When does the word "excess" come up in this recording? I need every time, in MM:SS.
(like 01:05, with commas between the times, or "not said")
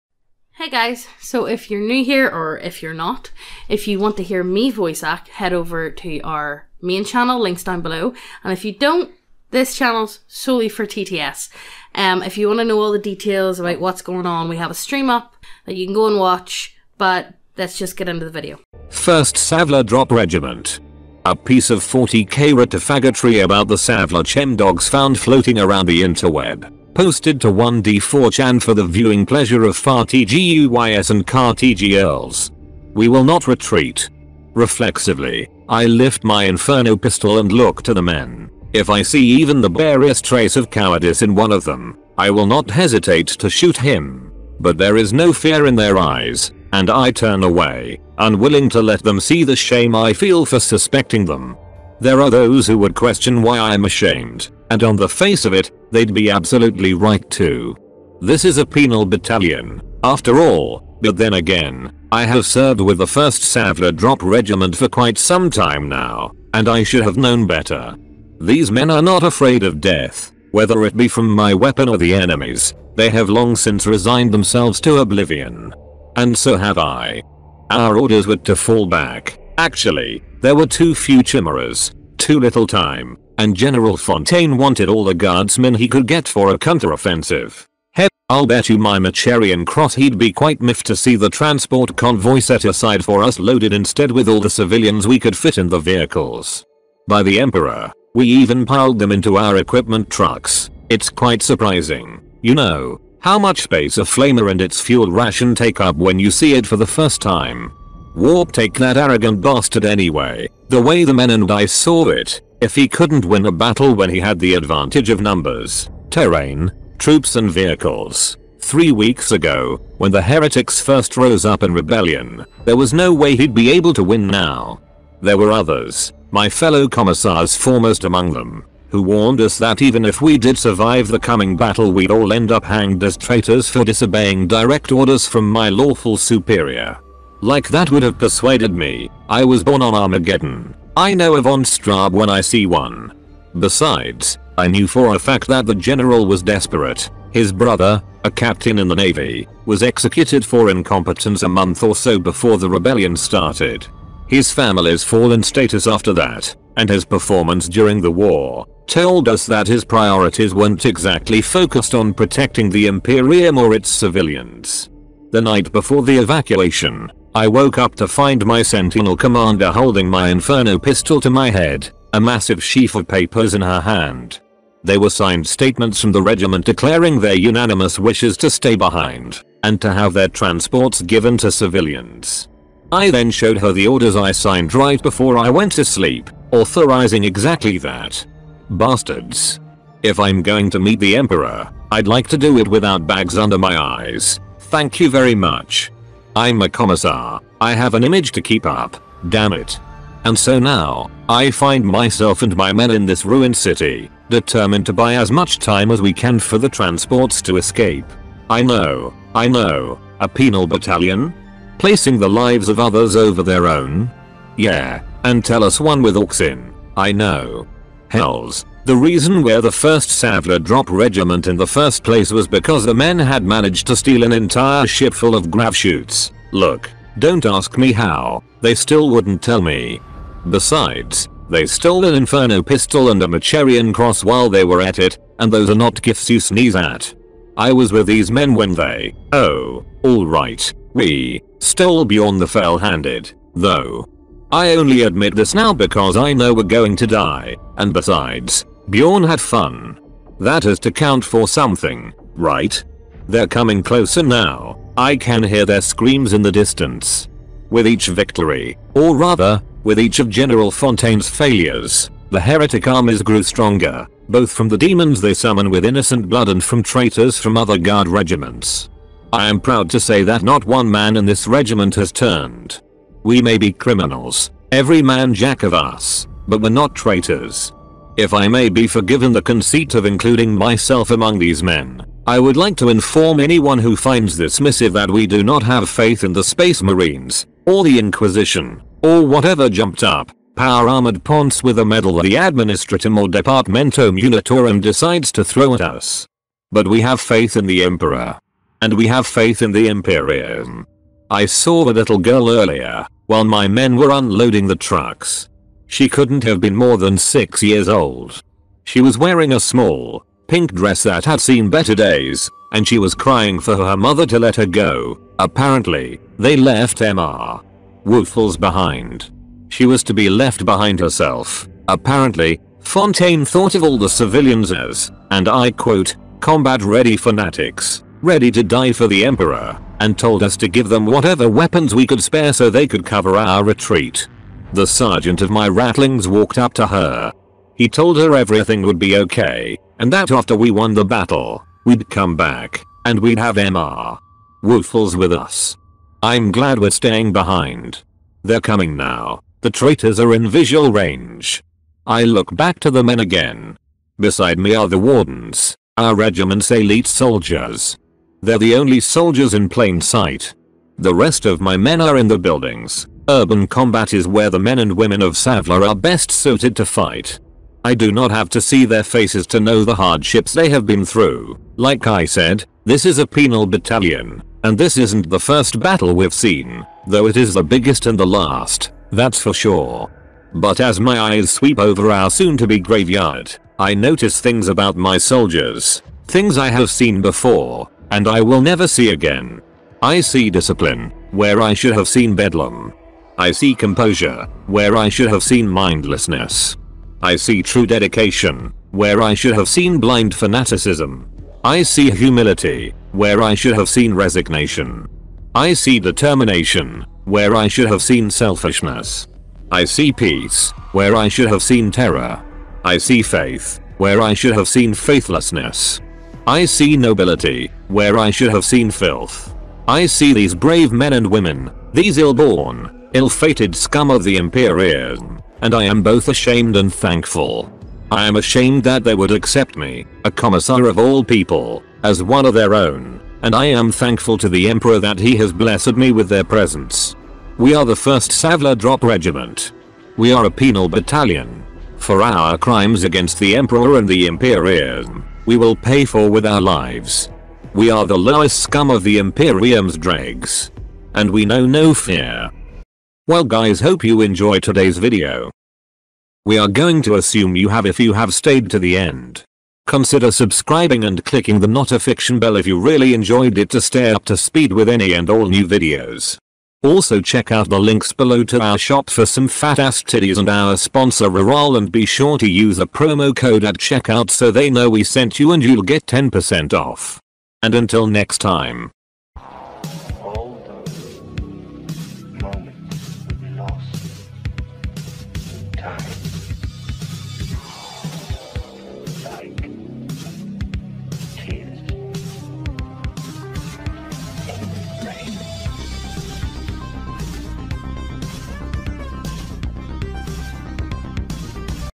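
not said.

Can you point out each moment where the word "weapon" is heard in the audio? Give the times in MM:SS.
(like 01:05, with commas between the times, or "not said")
01:11, 05:31.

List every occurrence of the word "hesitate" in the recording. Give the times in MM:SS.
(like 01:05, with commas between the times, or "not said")
00:42.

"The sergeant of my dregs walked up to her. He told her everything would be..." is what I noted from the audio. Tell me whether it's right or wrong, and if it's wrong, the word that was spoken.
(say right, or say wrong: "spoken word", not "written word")
wrong: "ratlings", not "dregs".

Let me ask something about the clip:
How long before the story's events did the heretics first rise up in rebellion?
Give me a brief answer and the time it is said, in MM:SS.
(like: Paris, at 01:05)
Three weeks, at 01:58.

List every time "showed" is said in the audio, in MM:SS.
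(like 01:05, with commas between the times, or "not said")
03:03.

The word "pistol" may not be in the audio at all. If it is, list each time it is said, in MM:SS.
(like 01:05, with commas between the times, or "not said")
00:36, 02:50, 03:52.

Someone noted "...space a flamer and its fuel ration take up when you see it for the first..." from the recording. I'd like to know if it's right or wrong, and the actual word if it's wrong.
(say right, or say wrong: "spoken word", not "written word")
right.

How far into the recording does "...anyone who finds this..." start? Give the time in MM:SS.
04:43.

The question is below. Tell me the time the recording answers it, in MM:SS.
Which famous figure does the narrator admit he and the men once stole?
04:02.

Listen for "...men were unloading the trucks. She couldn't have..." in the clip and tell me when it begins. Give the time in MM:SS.
05:03.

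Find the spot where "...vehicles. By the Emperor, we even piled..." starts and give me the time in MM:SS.
01:35.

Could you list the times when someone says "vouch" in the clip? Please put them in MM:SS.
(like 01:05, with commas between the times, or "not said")
not said.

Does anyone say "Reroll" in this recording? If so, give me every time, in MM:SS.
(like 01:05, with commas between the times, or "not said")
07:51.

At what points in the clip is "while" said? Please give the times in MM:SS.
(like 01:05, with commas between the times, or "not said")
03:54, 05:03.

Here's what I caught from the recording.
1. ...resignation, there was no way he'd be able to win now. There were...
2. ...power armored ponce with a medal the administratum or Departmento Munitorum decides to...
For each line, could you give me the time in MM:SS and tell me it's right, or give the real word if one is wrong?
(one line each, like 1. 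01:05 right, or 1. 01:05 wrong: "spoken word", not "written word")
1. 02:01 wrong: "rebellion", not "resignation"
2. 04:50 right.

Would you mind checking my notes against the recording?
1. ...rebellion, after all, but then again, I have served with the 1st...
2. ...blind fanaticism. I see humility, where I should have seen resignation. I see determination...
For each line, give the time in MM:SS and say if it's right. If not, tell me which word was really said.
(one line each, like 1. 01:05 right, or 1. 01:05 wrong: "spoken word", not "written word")
1. 00:59 wrong: "battalion", not "rebellion"
2. 06:39 right.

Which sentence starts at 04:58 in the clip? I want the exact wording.
And we have faith in the Imperium.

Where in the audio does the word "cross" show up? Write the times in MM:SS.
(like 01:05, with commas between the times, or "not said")
01:29, 03:53.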